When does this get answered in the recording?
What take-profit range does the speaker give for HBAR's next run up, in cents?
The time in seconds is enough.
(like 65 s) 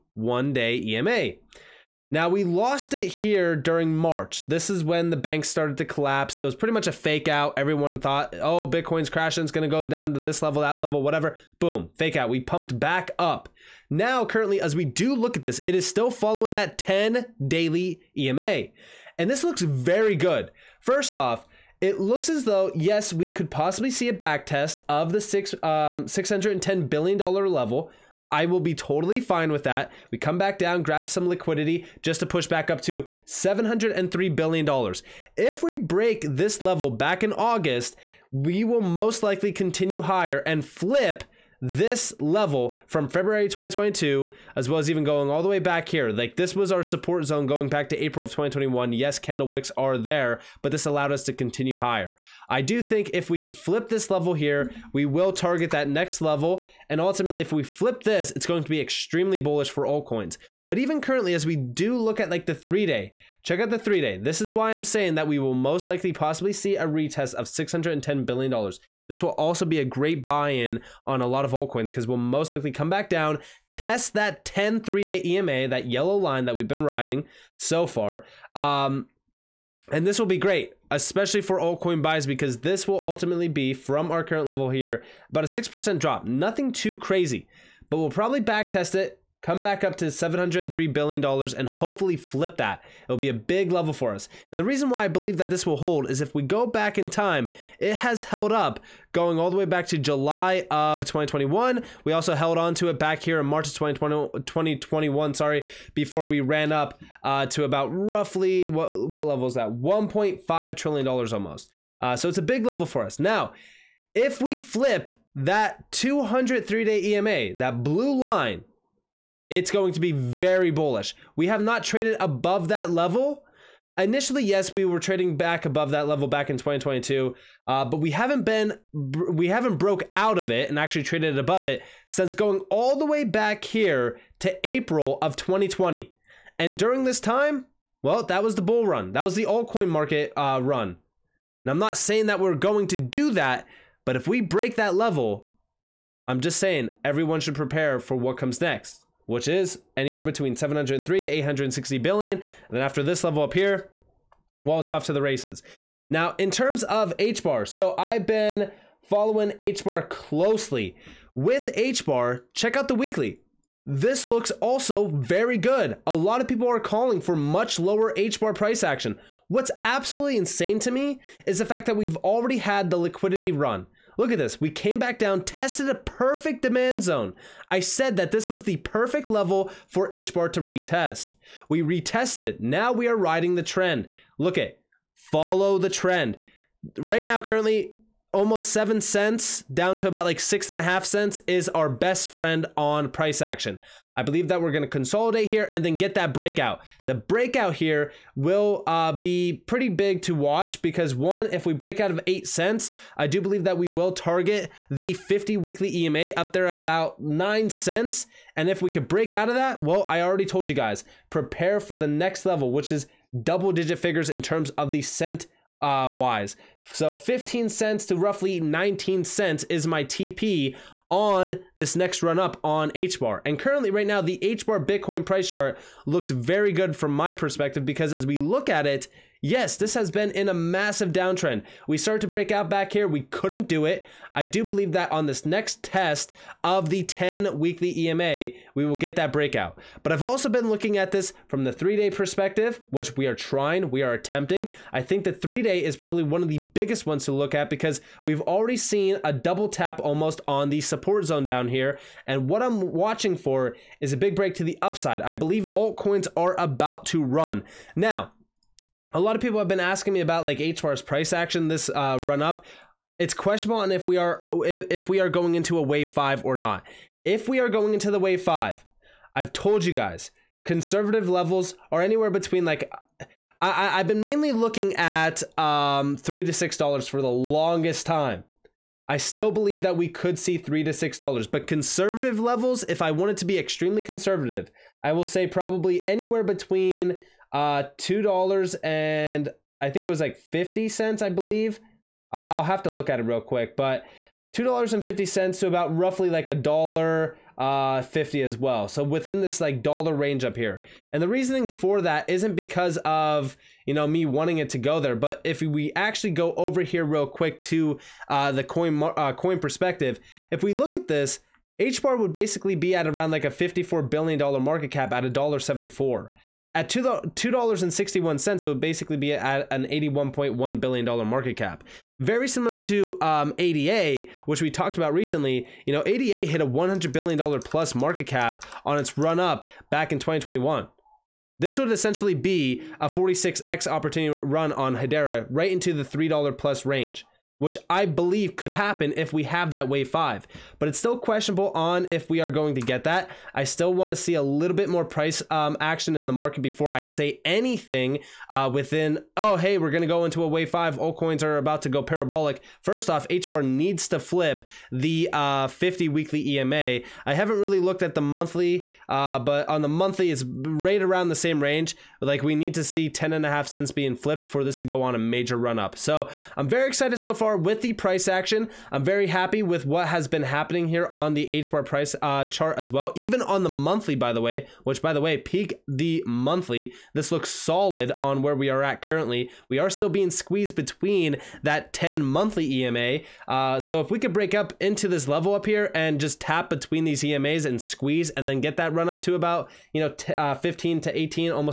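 217 s.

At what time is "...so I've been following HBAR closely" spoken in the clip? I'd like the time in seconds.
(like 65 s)
157 s.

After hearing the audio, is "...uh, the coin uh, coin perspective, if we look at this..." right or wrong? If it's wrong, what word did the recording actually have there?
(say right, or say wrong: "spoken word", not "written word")
right.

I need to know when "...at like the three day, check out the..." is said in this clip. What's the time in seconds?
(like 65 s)
62 s.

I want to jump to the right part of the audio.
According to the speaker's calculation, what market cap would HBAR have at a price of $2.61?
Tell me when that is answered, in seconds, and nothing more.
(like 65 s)
319 s.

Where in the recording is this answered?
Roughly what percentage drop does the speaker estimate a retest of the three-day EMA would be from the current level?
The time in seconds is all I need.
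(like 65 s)
85 s.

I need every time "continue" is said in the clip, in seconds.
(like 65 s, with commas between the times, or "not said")
39 s, 51 s.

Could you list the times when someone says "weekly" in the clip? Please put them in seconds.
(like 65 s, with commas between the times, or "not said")
162 s, 205 s, 237 s, 356 s.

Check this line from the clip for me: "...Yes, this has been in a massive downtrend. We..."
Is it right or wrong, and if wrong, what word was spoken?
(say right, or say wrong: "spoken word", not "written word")
right.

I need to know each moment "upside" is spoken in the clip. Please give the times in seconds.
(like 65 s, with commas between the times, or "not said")
254 s.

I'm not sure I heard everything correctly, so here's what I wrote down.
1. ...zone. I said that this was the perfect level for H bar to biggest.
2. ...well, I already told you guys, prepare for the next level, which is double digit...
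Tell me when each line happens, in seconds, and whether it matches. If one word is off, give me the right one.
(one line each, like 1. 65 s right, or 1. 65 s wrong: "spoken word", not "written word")
1. 177 s wrong: "retest", not "biggest"
2. 209 s right.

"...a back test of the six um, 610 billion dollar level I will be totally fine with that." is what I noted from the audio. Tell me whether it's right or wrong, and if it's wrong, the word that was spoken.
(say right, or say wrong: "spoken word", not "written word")
right.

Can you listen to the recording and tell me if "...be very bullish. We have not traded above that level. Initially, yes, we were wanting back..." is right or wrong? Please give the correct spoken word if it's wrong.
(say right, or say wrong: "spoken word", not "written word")
wrong: "trading", not "wanting".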